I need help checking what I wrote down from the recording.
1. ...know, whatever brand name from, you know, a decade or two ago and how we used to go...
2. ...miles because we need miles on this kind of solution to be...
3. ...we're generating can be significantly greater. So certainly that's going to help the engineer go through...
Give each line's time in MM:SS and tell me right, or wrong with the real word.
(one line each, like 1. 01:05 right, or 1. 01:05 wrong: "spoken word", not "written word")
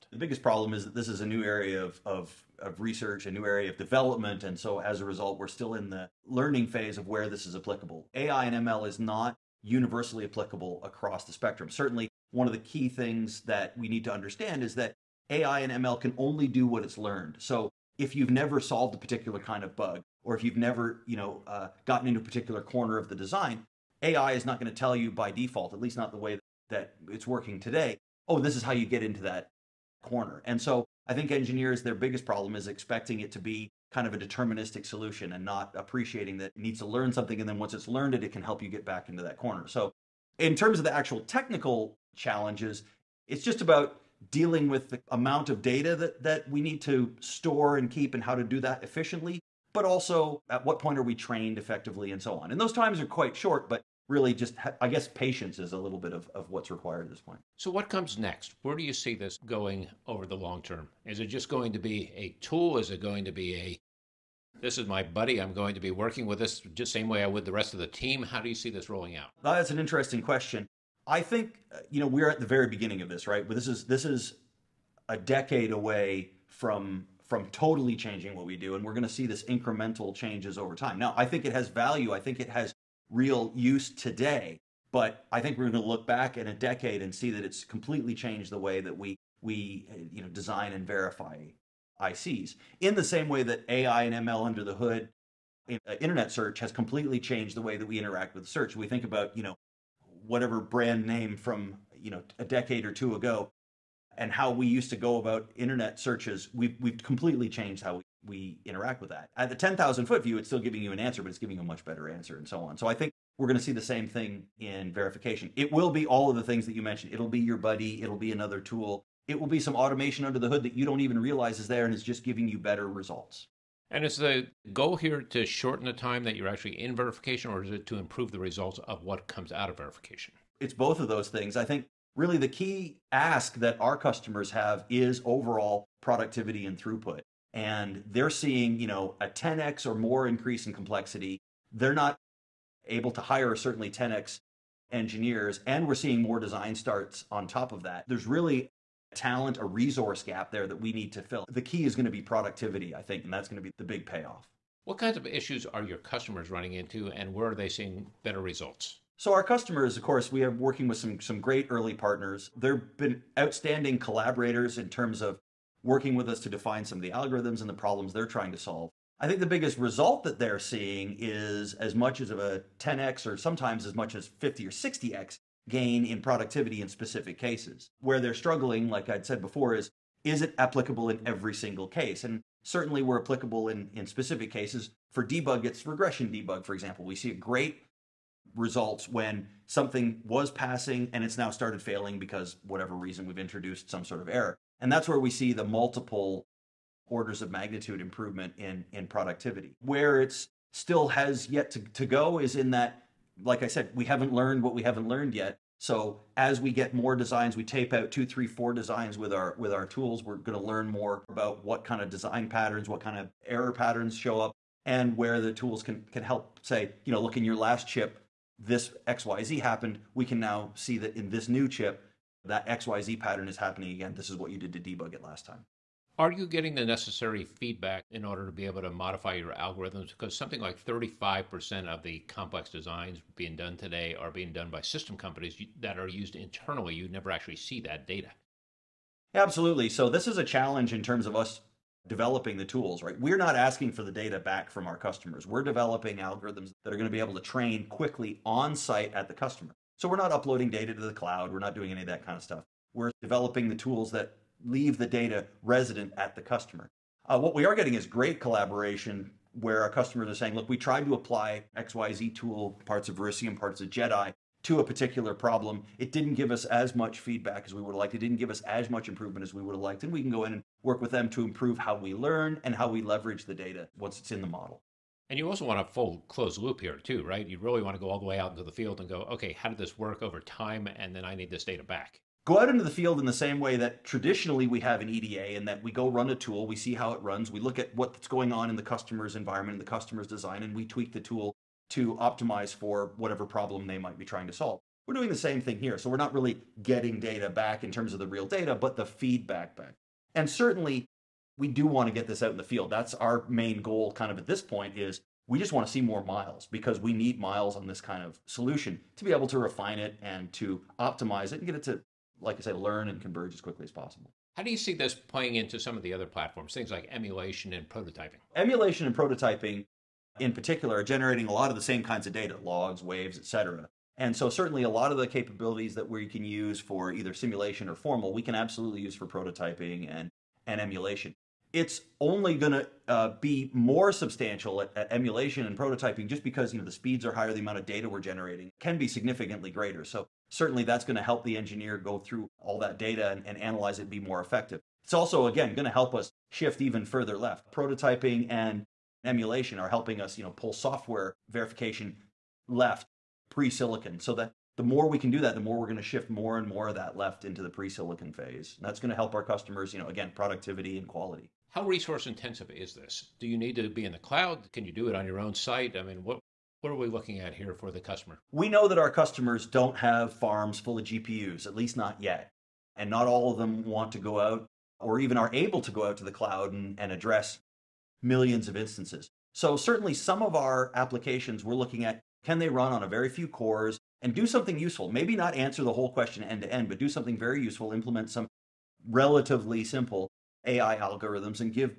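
1. 01:39 right
2. 05:06 right
3. 05:38 right.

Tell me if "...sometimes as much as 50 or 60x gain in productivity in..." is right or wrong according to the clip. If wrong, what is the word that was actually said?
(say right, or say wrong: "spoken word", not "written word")
right.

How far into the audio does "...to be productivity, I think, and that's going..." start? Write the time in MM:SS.
02:32.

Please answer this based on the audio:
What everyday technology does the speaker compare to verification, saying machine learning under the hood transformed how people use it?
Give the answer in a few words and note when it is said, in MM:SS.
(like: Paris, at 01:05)
internet search, at 01:35.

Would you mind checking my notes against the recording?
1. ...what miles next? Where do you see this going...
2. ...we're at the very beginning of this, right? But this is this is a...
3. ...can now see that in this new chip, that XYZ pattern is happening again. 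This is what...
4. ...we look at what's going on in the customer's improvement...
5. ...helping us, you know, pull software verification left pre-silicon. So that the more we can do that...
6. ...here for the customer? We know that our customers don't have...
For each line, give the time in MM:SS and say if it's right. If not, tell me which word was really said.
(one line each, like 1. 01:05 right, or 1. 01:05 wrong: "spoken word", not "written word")
1. 00:57 wrong: "comes", not "miles"
2. 01:12 right
3. 03:40 right
4. 04:47 wrong: "environment", not "improvement"
5. 05:49 right
6. 06:07 right.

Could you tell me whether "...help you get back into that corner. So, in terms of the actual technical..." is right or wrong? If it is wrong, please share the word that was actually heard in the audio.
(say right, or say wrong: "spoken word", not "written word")
right.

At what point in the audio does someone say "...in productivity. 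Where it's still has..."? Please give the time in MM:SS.
03:18.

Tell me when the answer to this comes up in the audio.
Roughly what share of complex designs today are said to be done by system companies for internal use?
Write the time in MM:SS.
03:50.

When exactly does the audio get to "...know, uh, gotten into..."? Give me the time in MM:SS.
00:21.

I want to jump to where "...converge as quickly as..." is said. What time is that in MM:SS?
05:13.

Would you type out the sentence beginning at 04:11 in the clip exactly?
We're not doing any of that kind of stuff.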